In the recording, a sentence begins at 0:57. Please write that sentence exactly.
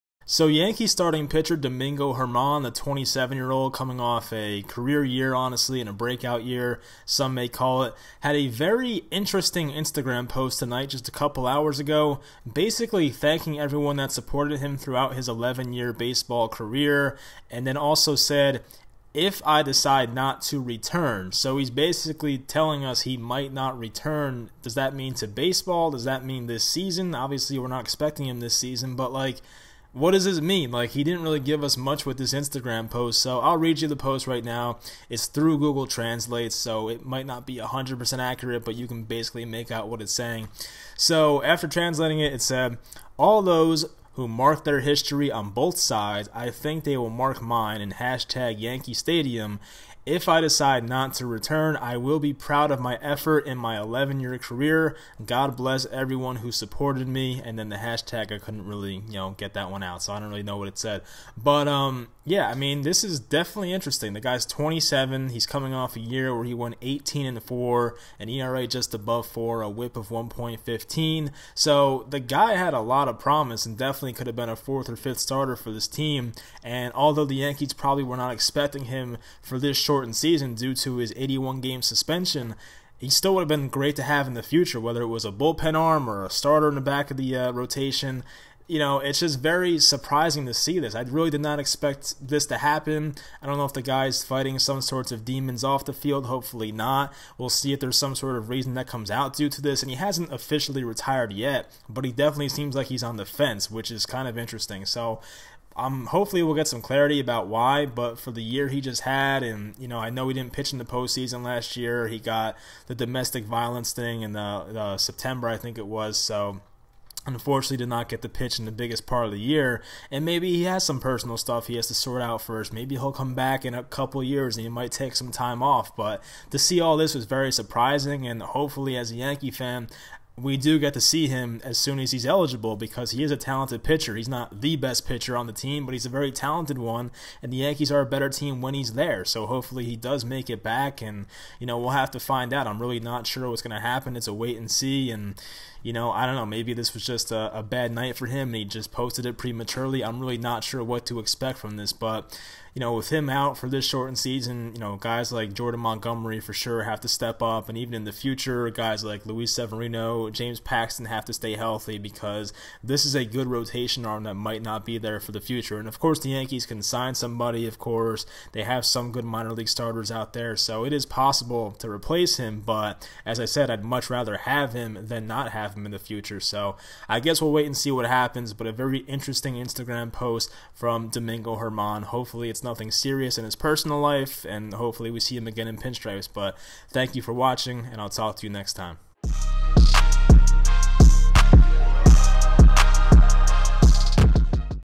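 And then the hashtag, I couldn't really, you know, get that one out, so I don't really know what it said.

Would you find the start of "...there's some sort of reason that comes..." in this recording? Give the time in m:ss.
1:37.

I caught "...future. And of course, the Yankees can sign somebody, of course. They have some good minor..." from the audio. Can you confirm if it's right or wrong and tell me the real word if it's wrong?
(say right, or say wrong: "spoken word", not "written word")
right.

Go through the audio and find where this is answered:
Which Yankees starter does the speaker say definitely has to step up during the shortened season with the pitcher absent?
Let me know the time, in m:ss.
2:35.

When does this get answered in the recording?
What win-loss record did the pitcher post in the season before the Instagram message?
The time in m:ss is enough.
1:06.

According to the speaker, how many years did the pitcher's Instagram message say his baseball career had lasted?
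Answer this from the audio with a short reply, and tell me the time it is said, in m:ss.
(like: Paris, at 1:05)
11, at 0:15.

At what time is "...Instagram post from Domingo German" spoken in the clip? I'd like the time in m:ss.
2:59.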